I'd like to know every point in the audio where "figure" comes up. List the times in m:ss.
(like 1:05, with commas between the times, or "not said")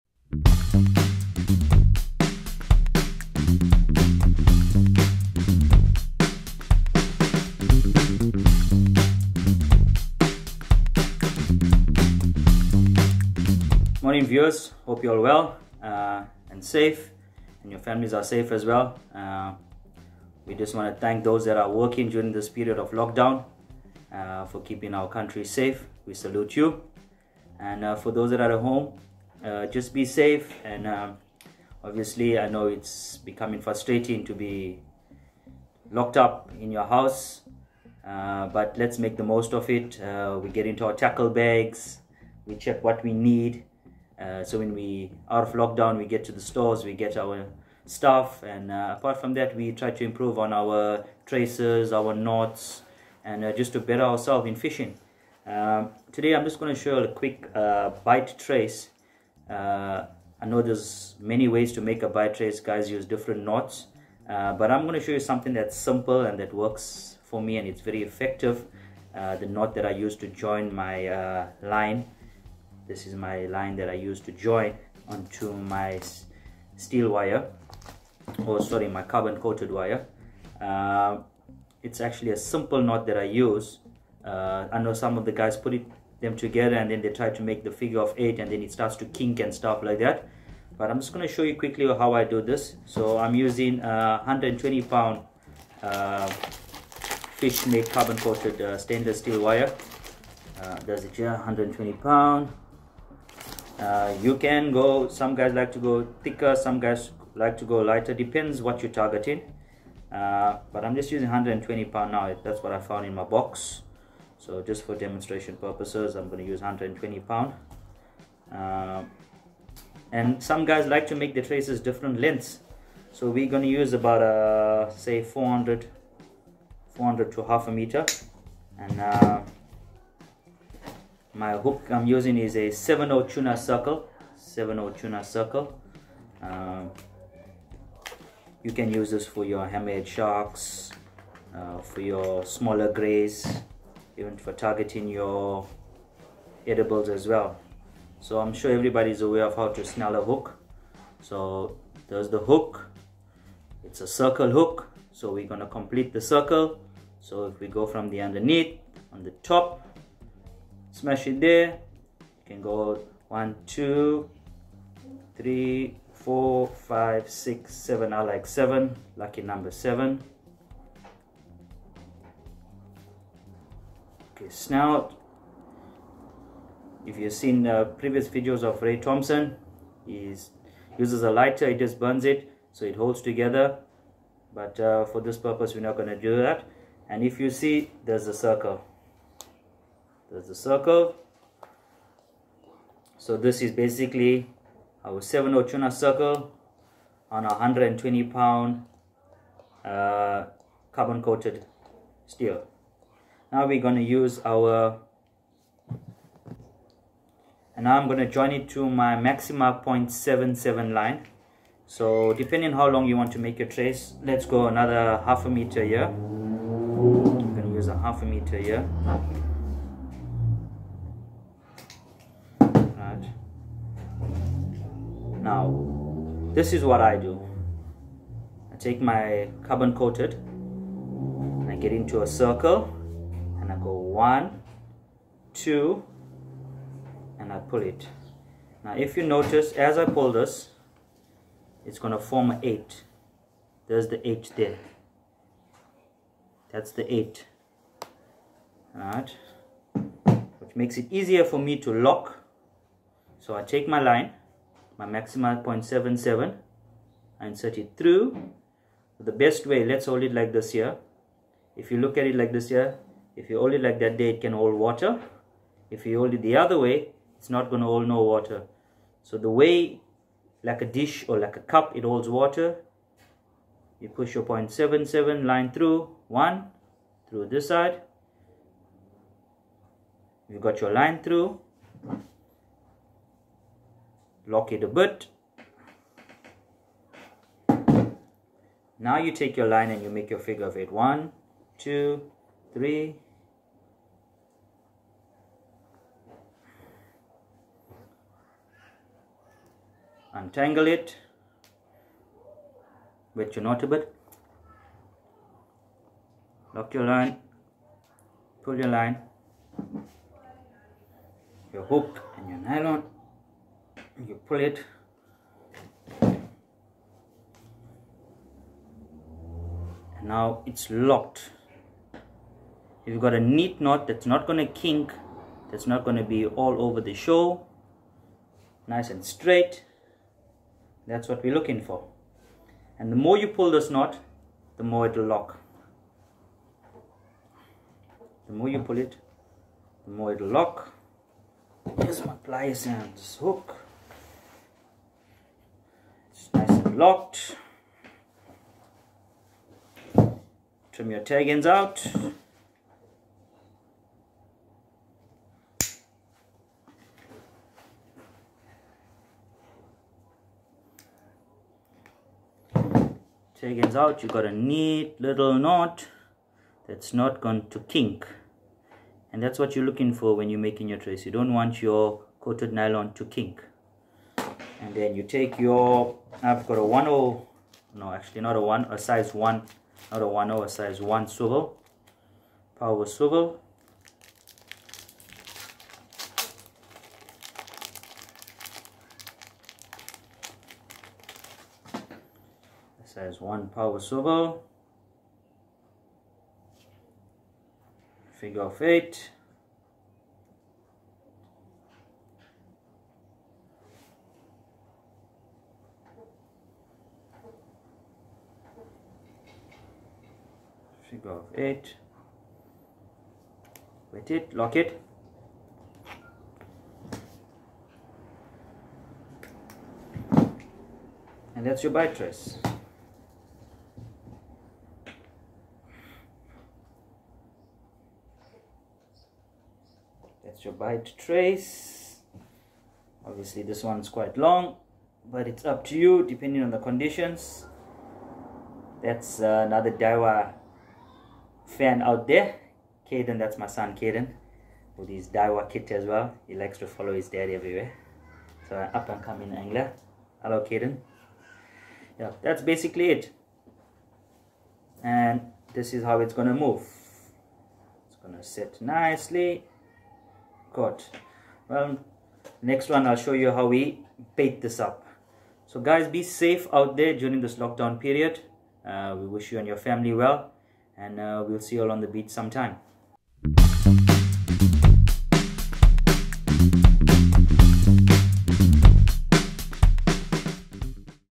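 1:27, 4:50, 6:38, 6:51.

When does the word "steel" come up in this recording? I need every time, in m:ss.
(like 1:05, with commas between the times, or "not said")
1:16, 1:39, 3:22.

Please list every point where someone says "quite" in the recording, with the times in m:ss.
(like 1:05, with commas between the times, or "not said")
7:14.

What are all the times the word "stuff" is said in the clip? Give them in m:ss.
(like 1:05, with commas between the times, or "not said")
0:47, 1:29.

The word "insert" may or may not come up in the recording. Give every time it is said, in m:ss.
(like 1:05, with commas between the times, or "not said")
4:17.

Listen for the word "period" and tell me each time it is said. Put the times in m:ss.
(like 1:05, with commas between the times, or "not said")
0:22, 7:47.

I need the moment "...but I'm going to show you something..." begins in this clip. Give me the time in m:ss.
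1:04.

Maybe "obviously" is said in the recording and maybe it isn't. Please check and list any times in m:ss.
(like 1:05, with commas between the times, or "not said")
0:31, 7:13.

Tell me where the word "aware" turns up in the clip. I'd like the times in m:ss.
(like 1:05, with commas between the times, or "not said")
2:29.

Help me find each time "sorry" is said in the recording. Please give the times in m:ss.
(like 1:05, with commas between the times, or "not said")
1:18.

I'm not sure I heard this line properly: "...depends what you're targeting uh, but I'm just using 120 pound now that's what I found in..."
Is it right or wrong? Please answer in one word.
right.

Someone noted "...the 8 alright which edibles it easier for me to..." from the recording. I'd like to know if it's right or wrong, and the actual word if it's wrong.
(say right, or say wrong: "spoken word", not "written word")
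wrong: "makes", not "edibles".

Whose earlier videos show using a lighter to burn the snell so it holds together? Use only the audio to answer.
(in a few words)
Ray Thompson.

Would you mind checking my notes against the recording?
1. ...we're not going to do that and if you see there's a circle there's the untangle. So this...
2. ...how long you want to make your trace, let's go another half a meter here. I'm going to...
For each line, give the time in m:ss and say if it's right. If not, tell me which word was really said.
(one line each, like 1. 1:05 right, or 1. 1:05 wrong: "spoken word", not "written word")
1. 3:05 wrong: "circle", not "untangle"
2. 3:32 right.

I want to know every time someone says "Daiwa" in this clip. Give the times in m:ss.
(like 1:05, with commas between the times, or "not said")
7:19, 7:25.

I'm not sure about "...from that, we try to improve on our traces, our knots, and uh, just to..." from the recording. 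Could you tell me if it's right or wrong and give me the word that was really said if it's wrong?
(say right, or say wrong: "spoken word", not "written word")
right.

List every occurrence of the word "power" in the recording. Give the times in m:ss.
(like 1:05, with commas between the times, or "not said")
6:22, 6:33.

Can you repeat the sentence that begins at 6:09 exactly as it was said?
And that's what you're looking for when you're making your trace.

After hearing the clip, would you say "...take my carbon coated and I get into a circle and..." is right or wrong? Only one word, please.
right.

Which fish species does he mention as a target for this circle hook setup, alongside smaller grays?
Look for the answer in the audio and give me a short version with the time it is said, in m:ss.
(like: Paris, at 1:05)
hammerhead sharks, at 2:19.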